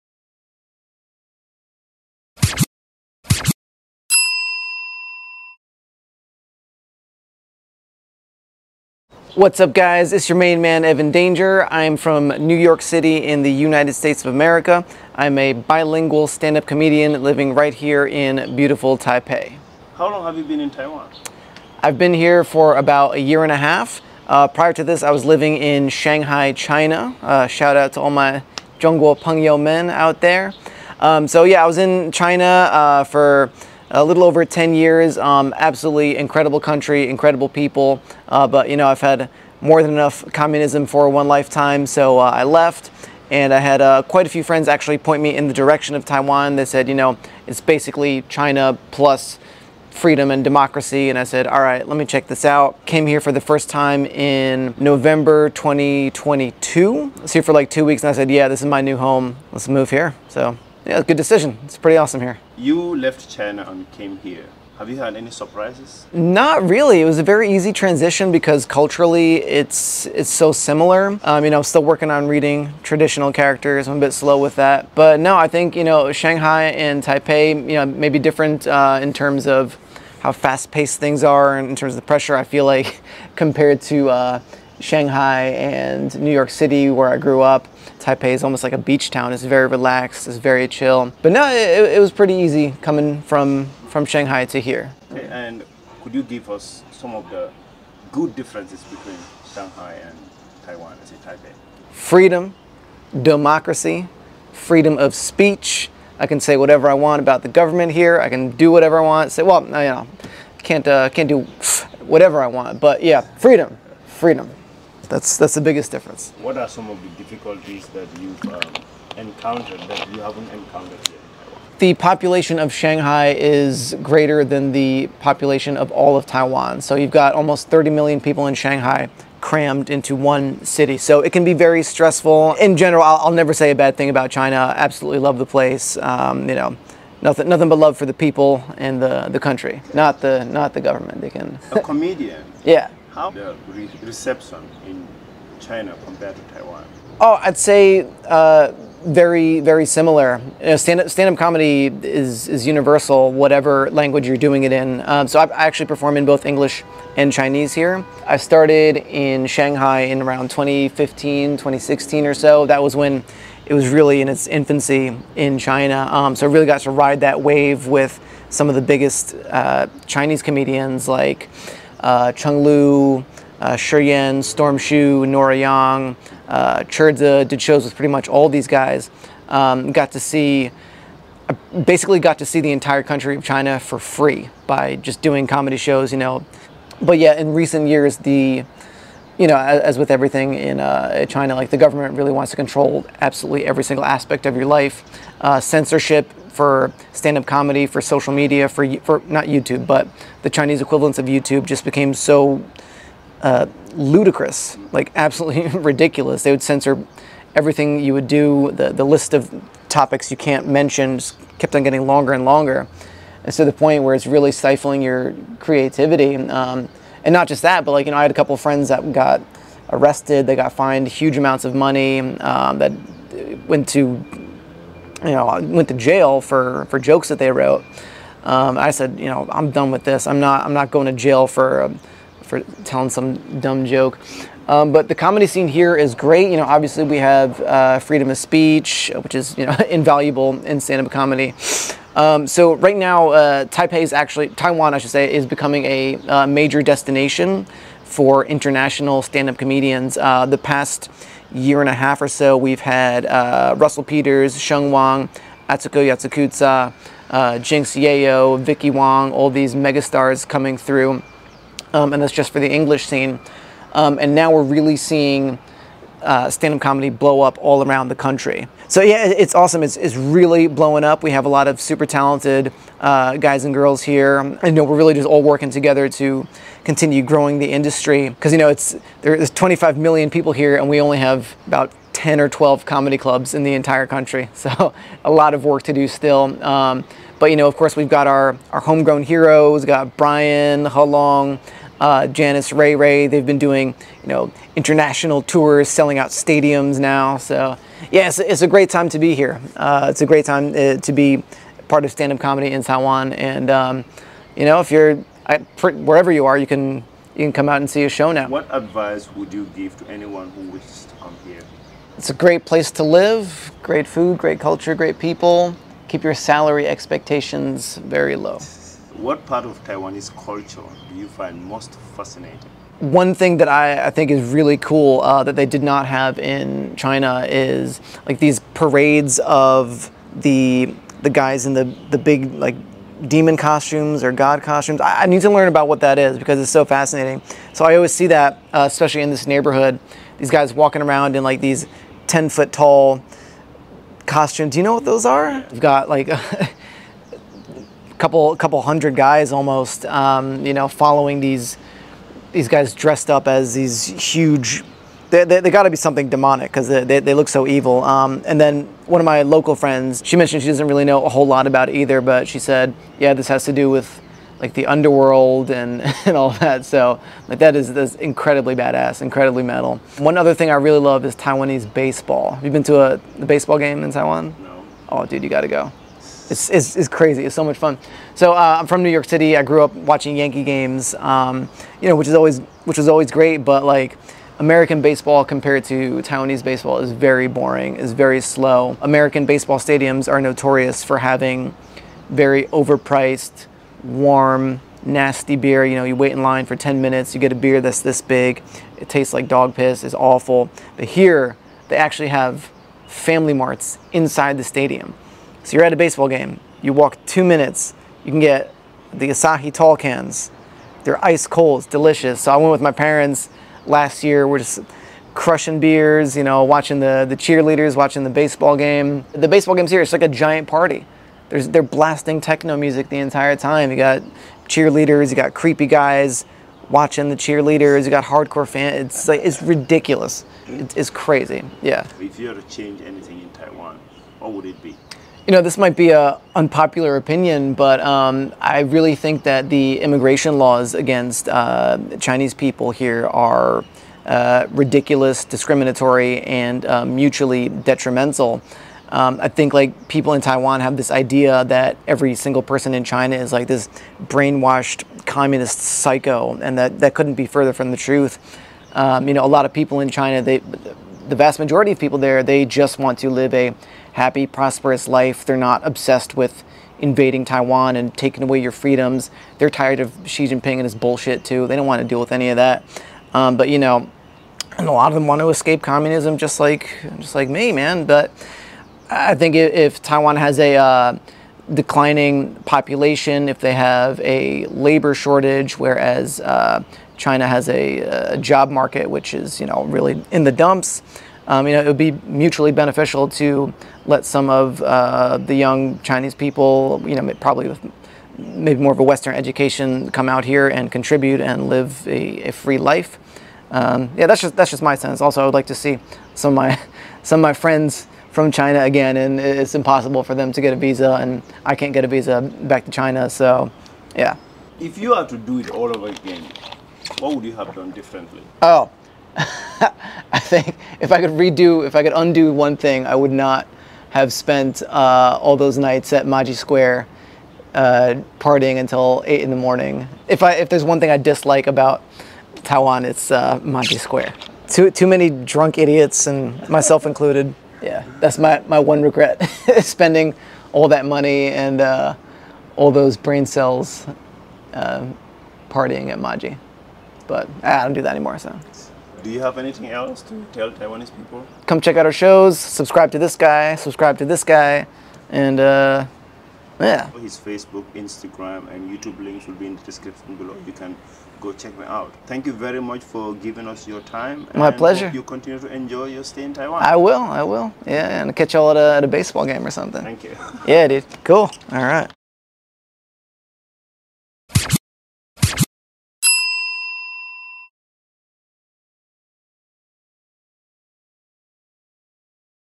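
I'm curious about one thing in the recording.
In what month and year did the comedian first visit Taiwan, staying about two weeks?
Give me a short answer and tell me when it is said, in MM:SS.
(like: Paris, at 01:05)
November 2022, at 00:54.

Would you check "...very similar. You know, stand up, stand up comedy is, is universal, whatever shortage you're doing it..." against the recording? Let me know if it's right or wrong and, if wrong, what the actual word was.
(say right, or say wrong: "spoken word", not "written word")
wrong: "language", not "shortage".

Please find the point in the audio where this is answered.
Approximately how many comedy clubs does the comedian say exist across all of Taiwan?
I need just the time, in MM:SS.
04:42.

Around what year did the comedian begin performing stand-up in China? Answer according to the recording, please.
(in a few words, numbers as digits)
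2015.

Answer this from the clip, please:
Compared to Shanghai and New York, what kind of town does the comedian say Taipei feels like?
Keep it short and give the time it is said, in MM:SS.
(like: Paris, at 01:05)
a beach town, at 01:28.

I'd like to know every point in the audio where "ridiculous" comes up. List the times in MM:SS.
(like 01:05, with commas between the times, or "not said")
03:25, 07:09, 07:24.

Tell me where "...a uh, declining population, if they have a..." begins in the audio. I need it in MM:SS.
08:00.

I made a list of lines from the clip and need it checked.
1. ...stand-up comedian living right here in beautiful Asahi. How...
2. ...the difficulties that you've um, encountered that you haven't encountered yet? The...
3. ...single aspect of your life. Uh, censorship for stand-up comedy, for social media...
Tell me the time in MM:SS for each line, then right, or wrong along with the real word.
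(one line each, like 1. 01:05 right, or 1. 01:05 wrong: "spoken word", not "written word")
1. 00:16 wrong: "Taipei", not "Asahi"
2. 01:57 right
3. 03:13 right.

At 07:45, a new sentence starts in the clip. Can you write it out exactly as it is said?
They're not obsessed with invading Taiwan and taking away your freedoms.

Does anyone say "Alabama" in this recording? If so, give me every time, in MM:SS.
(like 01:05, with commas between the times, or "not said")
not said.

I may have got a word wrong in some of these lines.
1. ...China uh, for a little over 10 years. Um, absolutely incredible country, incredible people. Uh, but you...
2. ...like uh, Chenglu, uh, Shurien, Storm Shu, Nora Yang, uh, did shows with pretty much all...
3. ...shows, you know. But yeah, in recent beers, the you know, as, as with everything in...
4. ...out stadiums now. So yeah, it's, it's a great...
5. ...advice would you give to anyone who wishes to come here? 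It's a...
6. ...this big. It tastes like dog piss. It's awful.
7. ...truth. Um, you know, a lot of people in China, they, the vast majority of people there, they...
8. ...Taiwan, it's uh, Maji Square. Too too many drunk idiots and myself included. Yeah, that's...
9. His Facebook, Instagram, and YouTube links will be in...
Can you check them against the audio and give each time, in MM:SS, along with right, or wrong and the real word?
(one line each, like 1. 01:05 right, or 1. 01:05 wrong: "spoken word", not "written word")
1. 00:32 right
2. 02:51 right
3. 03:05 wrong: "years", not "beers"
4. 04:56 right
5. 05:08 right
6. 06:38 right
7. 07:37 right
8. 08:52 right
9. 09:17 right.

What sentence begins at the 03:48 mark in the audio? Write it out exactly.
Um, I said, you know, I'm done with this.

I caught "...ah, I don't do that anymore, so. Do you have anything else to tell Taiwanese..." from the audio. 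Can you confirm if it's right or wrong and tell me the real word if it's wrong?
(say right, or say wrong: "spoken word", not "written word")
right.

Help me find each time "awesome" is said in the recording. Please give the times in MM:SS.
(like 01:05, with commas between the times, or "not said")
01:01, 04:29.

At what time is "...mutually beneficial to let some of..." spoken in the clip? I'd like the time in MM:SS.
08:12.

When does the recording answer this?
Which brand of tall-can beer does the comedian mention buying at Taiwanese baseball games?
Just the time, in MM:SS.
06:49.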